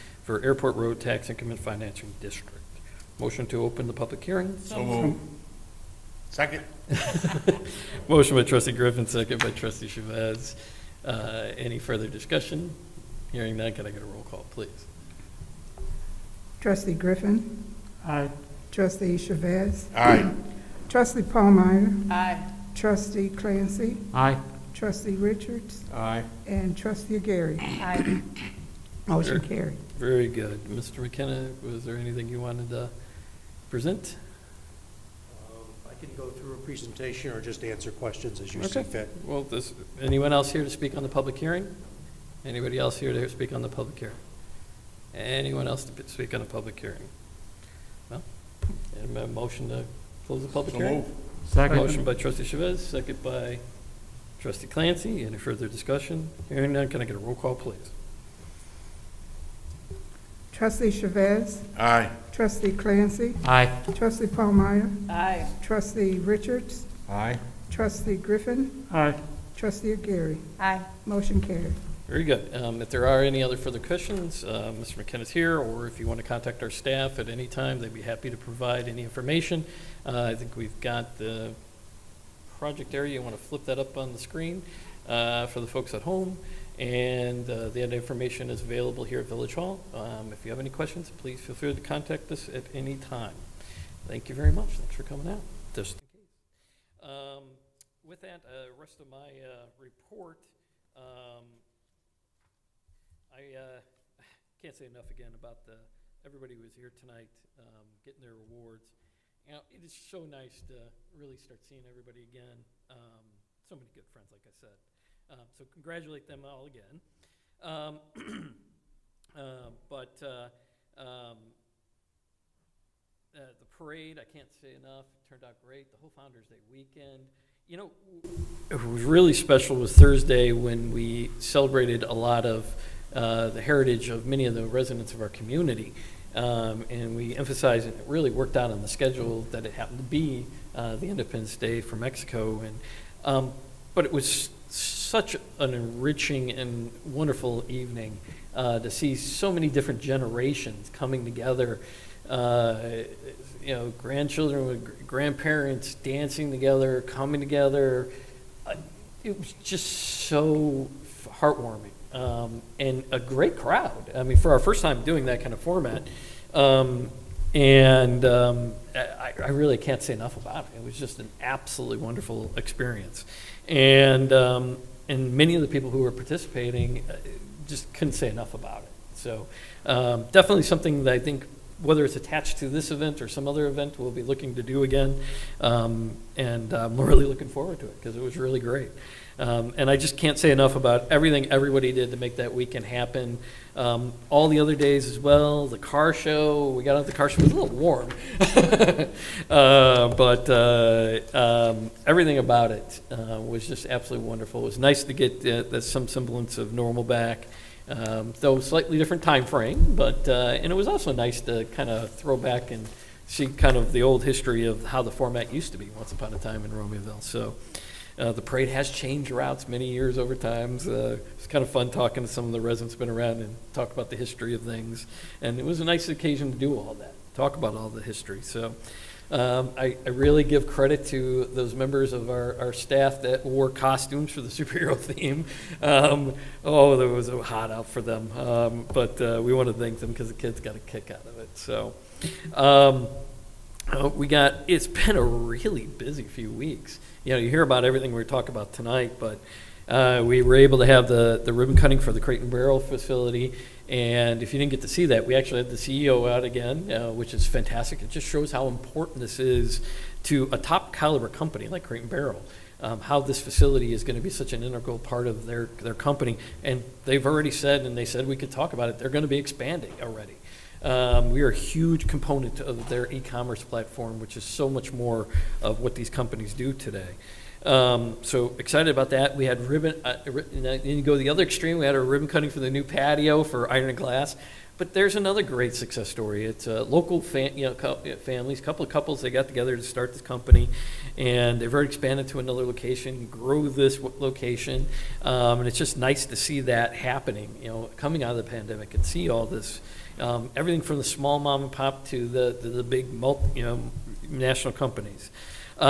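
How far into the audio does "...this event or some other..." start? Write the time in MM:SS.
03:02.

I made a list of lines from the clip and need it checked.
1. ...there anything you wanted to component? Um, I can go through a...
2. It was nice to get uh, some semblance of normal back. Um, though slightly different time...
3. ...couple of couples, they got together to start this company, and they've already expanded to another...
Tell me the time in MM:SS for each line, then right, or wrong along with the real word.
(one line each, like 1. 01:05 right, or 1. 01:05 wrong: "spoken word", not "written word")
1. 00:31 wrong: "present", not "component"
2. 03:24 right
3. 04:48 right.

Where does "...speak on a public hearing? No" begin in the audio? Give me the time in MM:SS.
00:46.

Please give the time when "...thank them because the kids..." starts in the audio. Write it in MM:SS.
03:59.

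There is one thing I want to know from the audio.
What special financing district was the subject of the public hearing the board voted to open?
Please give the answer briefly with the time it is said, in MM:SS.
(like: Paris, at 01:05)
Airport Road Tax Increment Financing District, at 00:00.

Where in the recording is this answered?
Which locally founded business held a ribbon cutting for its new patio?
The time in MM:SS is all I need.
04:43.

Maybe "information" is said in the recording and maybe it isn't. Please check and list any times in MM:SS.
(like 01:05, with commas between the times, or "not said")
01:19, 01:27.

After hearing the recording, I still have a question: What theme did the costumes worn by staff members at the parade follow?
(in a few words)
superhero.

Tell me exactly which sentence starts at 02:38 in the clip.
Uh, it was just so heartwarming um, and a great crowd.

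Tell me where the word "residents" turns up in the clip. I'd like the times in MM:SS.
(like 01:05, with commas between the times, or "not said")
02:14, 03:42.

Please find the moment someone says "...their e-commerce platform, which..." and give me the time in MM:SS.
04:32.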